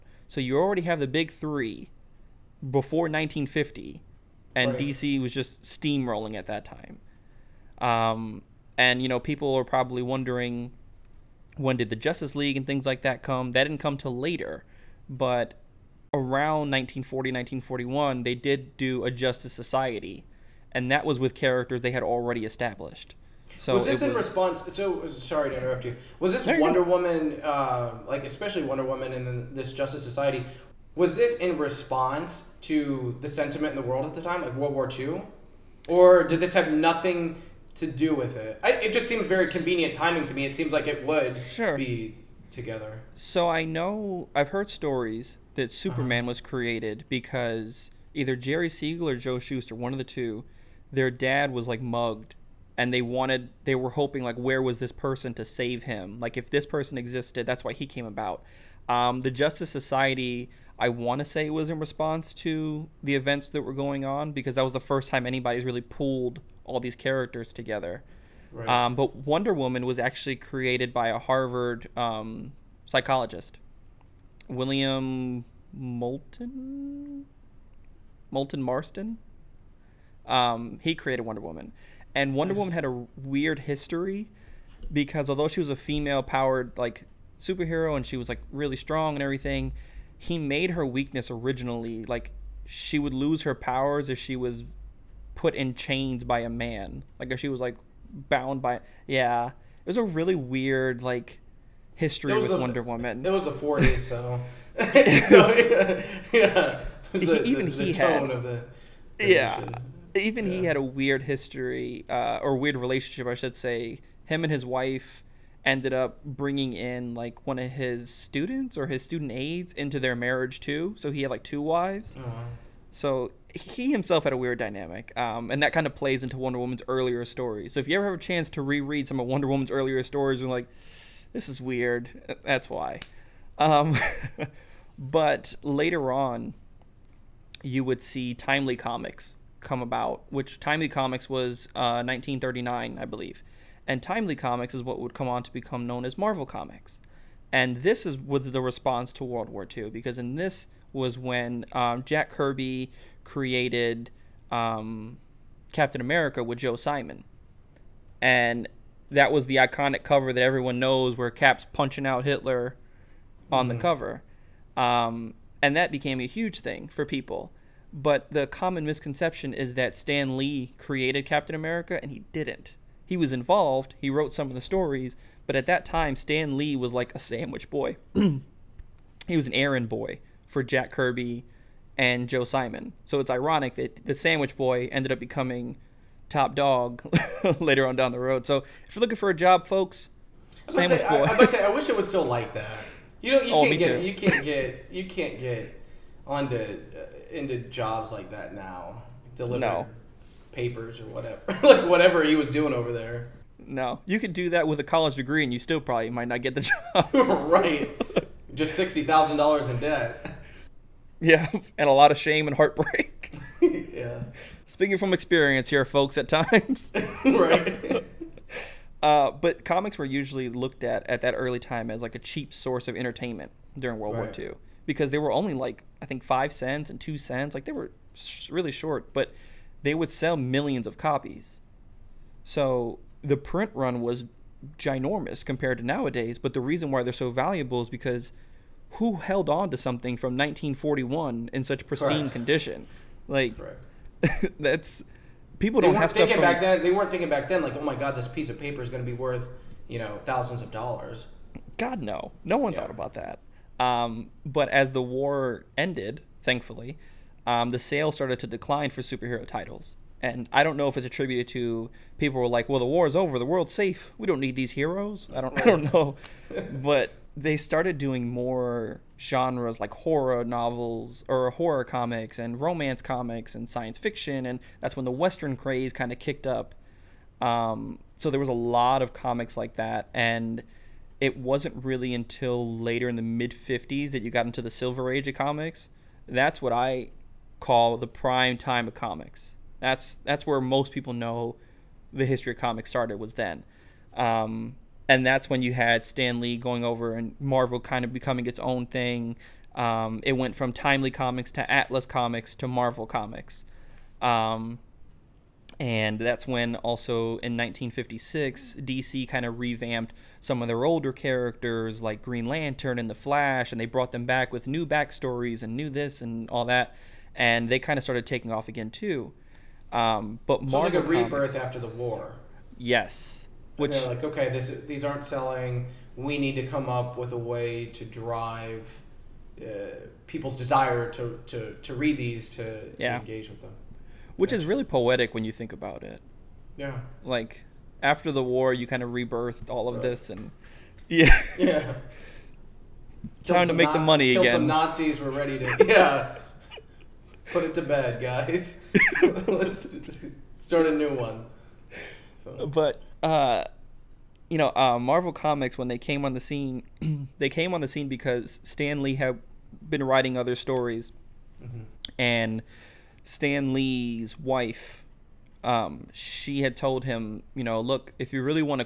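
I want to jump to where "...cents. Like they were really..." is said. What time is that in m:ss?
3:47.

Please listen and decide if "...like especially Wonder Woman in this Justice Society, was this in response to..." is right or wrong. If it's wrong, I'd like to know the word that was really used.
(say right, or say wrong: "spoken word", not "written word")
right.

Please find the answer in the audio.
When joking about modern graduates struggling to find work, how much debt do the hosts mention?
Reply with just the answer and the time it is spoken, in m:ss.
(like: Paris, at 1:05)
$60,000, at 3:28.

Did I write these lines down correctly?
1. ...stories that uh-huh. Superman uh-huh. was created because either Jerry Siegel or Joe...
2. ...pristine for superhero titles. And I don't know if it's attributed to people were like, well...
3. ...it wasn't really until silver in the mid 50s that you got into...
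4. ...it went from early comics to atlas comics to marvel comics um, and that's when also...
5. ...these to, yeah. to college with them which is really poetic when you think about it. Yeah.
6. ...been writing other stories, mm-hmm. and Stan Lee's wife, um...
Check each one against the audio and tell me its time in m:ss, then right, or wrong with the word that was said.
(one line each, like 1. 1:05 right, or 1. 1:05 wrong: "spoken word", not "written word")
1. 0:44 right
2. 4:18 wrong: "decline", not "pristine"
3. 4:41 wrong: "later", not "silver"
4. 5:00 wrong: "timely", not "early"
5. 5:32 wrong: "engage", not "college"
6. 5:59 right.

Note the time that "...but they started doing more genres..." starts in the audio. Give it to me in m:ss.
4:26.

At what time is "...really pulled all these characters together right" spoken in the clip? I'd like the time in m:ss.
1:05.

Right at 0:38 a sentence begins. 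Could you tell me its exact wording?
I, it just seems very convenient timing to me.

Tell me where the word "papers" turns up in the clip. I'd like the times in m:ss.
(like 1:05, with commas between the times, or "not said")
3:20, 4:08.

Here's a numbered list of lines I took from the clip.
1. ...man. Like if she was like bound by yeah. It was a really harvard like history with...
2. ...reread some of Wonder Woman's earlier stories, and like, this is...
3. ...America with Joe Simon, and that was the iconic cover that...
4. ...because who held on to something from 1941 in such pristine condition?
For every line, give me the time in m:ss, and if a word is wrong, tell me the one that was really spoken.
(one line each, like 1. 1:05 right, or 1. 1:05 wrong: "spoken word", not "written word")
1. 1:36 wrong: "weird", not "harvard"
2. 2:08 right
3. 2:36 right
4. 3:57 right.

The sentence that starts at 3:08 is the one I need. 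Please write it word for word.
So if you're looking for a job, folks, sandwich say, boy.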